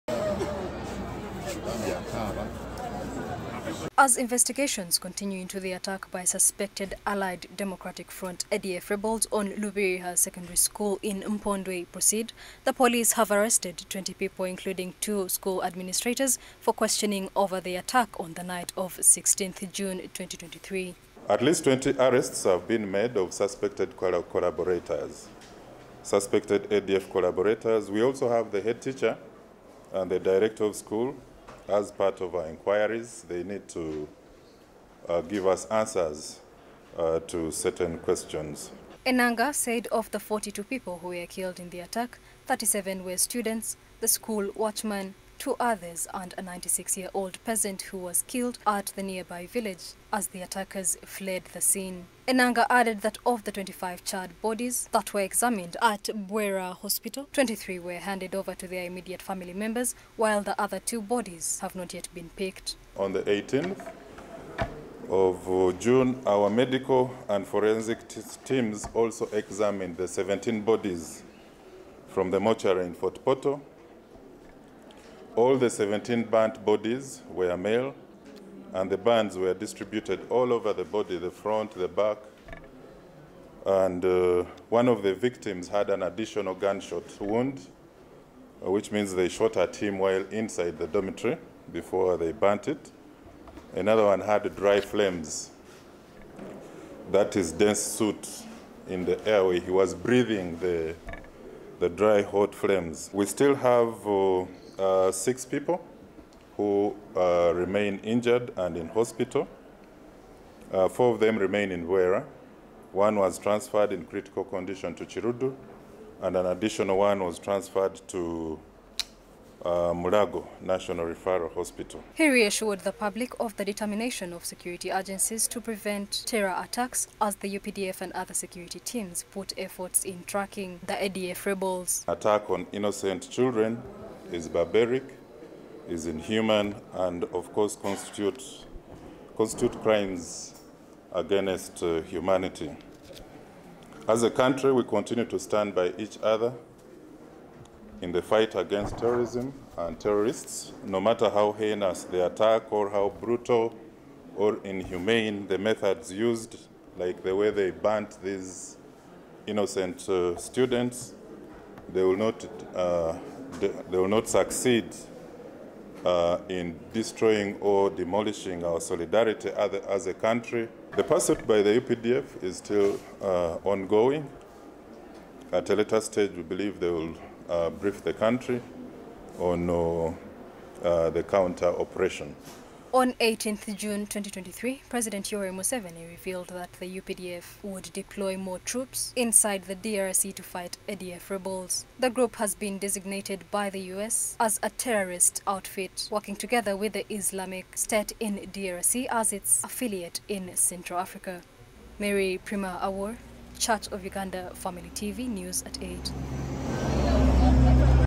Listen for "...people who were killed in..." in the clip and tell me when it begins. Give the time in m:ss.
0:40.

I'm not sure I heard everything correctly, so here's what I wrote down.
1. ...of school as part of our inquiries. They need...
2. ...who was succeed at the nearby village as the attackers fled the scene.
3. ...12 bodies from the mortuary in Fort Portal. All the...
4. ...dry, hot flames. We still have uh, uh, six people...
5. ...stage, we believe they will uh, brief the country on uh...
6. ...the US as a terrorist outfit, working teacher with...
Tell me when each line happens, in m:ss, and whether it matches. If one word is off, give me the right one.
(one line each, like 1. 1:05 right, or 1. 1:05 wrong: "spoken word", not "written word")
1. 0:30 right
2. 0:47 wrong: "killed", not "succeed"
3. 1:10 wrong: "17", not "12"
4. 1:41 right
5. 2:56 right
6. 3:13 wrong: "together", not "teacher".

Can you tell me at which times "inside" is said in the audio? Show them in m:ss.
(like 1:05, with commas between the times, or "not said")
1:30, 3:09.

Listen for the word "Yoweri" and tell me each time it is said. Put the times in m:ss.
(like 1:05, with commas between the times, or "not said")
3:05.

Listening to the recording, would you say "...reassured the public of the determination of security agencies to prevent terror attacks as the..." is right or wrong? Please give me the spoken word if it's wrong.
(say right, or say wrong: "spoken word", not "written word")
right.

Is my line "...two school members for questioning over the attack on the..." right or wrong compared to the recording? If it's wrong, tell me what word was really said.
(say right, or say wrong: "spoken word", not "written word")
wrong: "administrators", not "members".